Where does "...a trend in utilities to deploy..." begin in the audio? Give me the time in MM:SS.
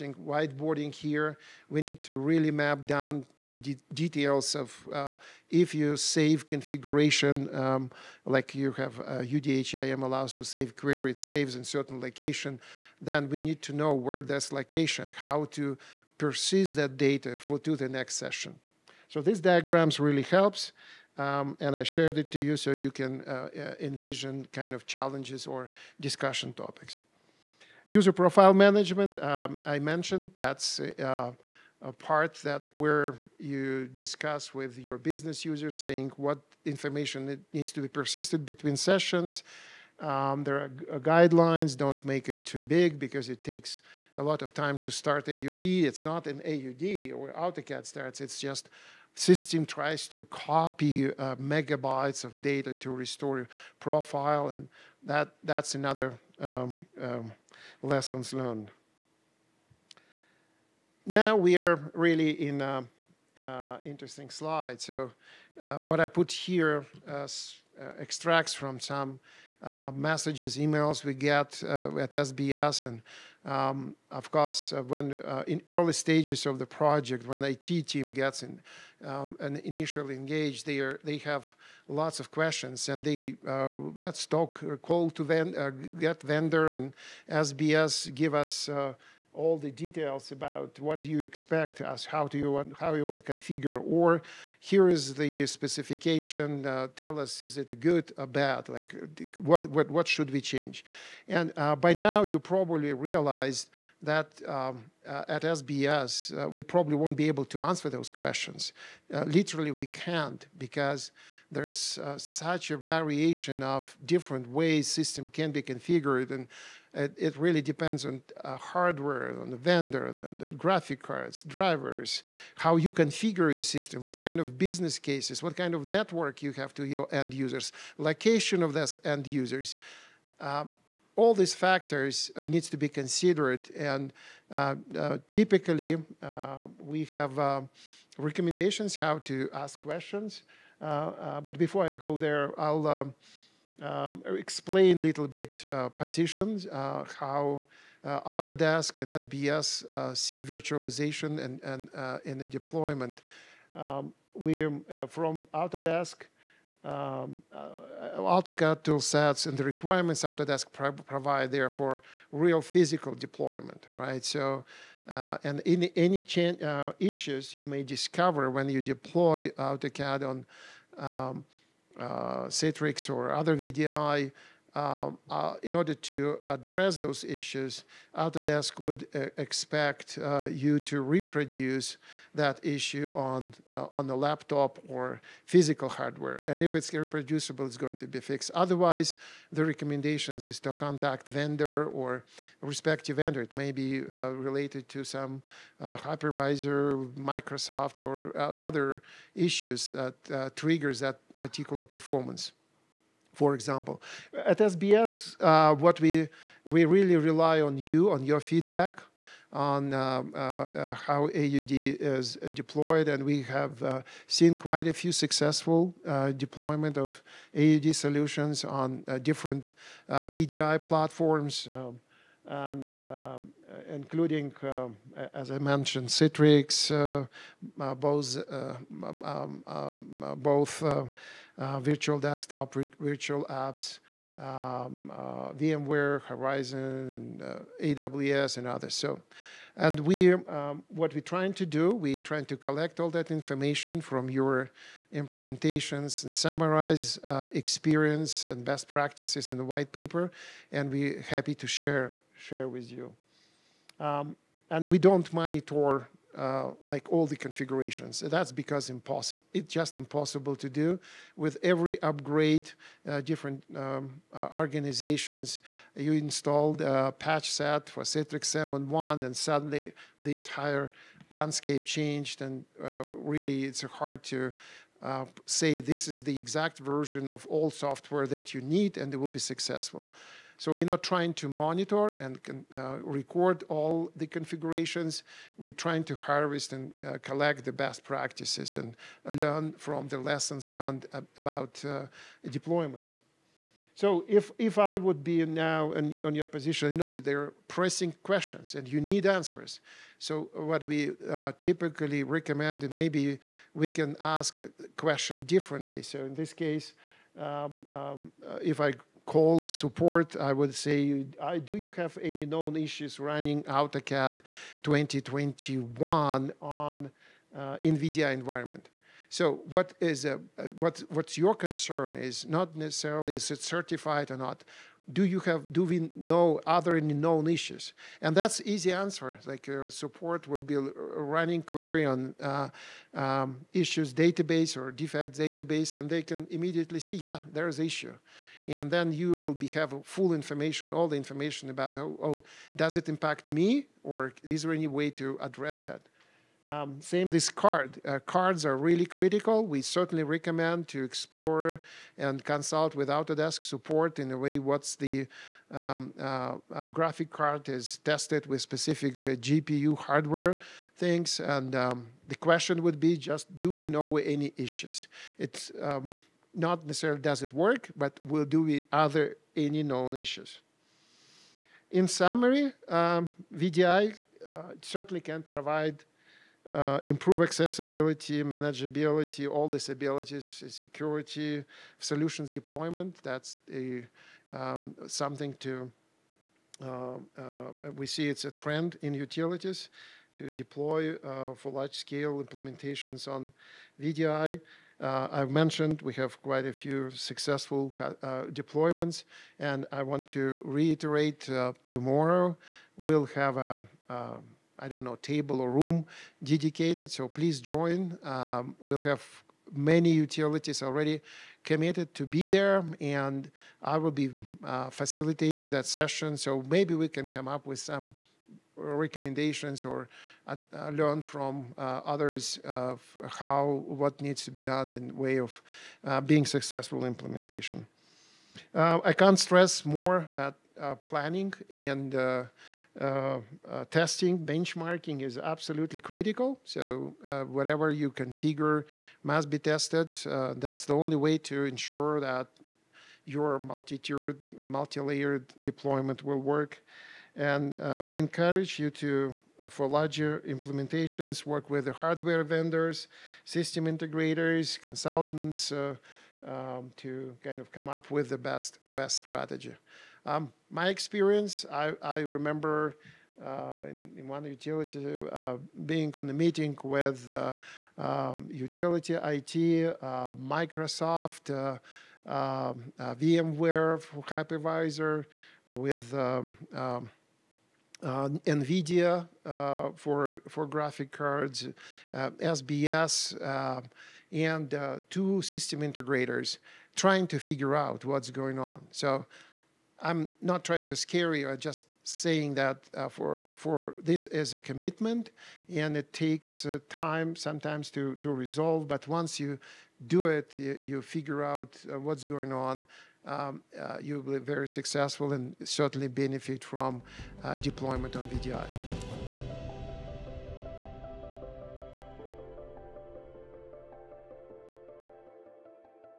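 06:28.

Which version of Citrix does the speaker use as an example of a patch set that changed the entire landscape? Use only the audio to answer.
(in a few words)
7.1.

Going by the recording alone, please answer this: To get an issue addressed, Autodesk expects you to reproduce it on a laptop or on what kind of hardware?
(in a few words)
physical hardware.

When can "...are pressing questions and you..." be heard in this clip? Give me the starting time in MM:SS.
04:57.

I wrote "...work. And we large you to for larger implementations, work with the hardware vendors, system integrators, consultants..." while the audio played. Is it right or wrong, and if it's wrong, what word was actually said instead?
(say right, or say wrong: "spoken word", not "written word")
wrong: "encourage", not "large".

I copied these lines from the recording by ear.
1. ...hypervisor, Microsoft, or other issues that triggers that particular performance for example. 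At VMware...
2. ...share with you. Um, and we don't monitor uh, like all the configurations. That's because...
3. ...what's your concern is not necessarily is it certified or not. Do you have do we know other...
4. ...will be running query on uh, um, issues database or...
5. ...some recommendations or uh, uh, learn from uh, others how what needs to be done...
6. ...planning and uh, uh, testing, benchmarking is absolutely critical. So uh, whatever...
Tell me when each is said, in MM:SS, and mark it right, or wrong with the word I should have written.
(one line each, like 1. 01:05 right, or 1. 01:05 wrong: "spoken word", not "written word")
1. 03:15 wrong: "SBS", not "VMware"
2. 04:12 right
3. 05:21 right
4. 05:30 right
5. 06:57 right
6. 07:11 right.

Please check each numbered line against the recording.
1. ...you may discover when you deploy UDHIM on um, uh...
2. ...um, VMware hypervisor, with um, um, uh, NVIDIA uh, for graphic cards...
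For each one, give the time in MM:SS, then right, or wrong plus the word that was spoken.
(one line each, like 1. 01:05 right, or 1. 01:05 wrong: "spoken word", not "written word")
1. 02:47 wrong: "AutoCAD", not "UDHIM"
2. 07:52 right.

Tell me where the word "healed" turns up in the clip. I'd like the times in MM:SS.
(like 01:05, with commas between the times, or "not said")
not said.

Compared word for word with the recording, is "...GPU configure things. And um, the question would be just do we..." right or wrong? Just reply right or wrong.
wrong.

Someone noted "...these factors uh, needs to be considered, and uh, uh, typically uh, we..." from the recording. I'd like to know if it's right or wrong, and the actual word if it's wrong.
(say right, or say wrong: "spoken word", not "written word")
right.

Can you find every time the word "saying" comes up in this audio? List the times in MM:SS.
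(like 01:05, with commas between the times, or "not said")
00:35, 08:12.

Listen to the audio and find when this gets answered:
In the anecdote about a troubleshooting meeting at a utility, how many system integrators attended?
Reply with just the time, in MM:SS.
08:05.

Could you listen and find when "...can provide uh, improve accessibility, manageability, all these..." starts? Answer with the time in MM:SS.
06:15.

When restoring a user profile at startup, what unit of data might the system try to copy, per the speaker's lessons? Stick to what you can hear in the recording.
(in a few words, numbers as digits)
megabytes.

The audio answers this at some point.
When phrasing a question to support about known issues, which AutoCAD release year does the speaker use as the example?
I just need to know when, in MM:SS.
05:13.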